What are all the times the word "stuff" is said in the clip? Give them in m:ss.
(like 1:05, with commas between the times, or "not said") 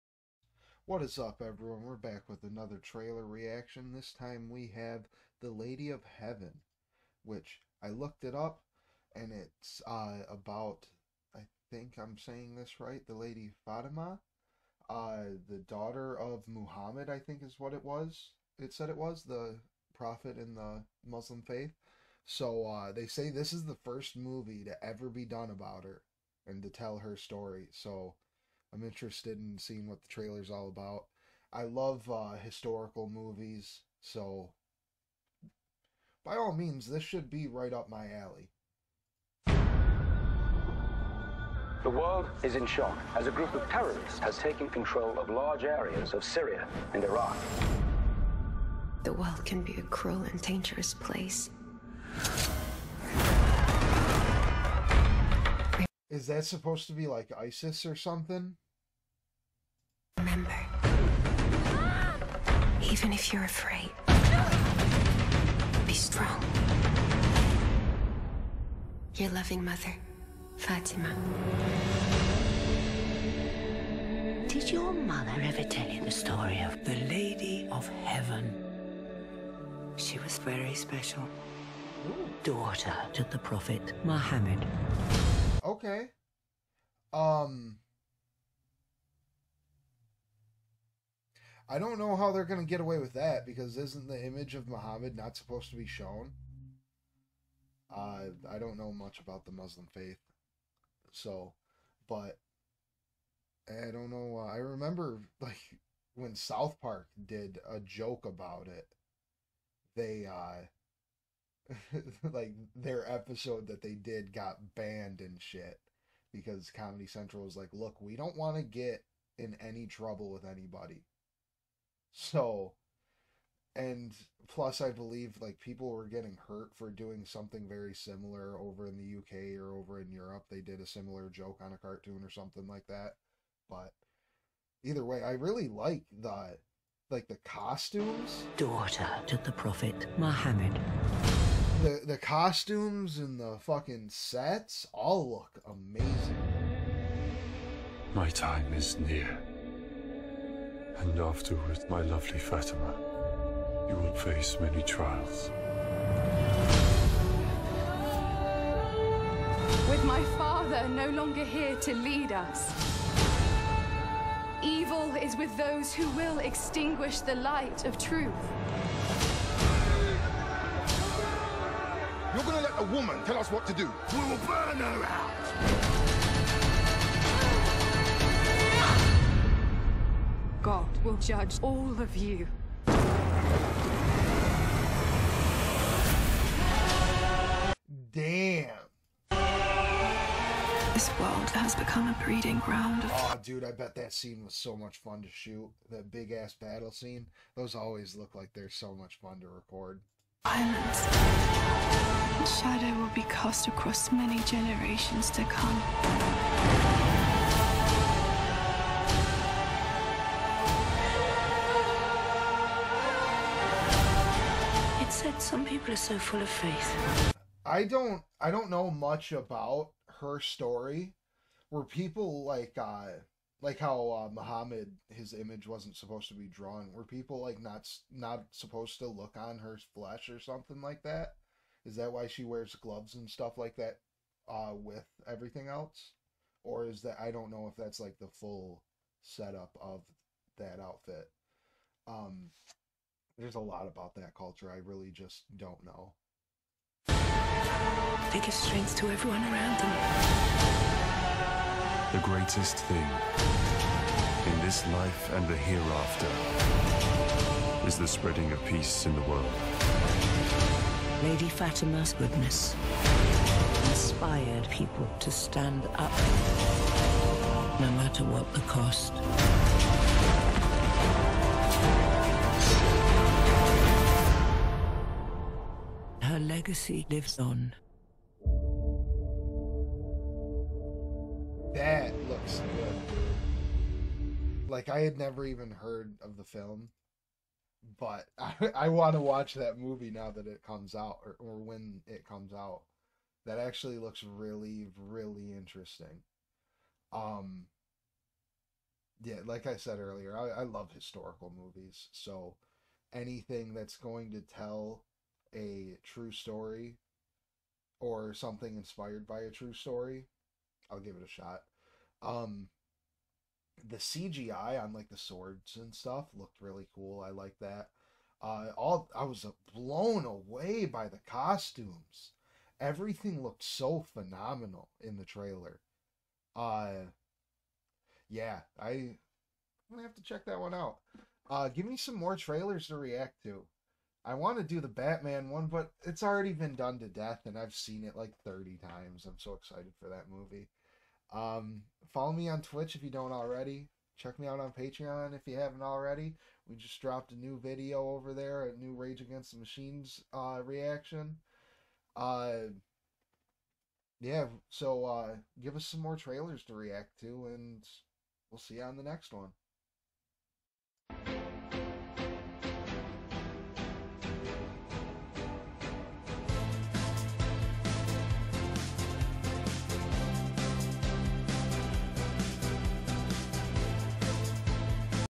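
3:53, 5:15.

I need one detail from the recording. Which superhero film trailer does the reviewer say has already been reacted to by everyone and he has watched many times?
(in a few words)
The Batman.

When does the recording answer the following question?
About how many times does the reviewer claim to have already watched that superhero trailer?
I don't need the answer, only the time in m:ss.
5:38.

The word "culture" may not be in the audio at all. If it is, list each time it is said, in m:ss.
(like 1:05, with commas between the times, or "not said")
4:04.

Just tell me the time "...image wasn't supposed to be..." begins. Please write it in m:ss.
3:45.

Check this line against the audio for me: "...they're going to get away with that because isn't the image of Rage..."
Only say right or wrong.
wrong.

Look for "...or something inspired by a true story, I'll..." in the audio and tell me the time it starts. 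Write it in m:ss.
5:07.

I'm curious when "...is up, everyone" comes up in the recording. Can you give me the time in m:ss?
0:01.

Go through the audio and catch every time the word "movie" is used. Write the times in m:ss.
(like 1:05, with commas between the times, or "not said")
0:24, 0:33, 4:49, 5:01, 5:40.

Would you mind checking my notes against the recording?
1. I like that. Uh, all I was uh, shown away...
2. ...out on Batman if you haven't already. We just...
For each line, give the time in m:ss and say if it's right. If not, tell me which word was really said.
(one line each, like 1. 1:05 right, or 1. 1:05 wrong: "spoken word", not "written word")
1. 5:17 wrong: "blown", not "shown"
2. 5:44 wrong: "Patreon", not "Batman".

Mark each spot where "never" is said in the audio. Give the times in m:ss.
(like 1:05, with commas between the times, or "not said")
4:45.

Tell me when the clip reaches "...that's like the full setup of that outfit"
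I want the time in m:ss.
3:57.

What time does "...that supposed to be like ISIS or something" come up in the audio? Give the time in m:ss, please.
0:56.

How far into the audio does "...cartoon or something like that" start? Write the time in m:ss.
2:11.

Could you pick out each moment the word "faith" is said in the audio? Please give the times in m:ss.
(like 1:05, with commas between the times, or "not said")
0:21, 1:39, 3:36.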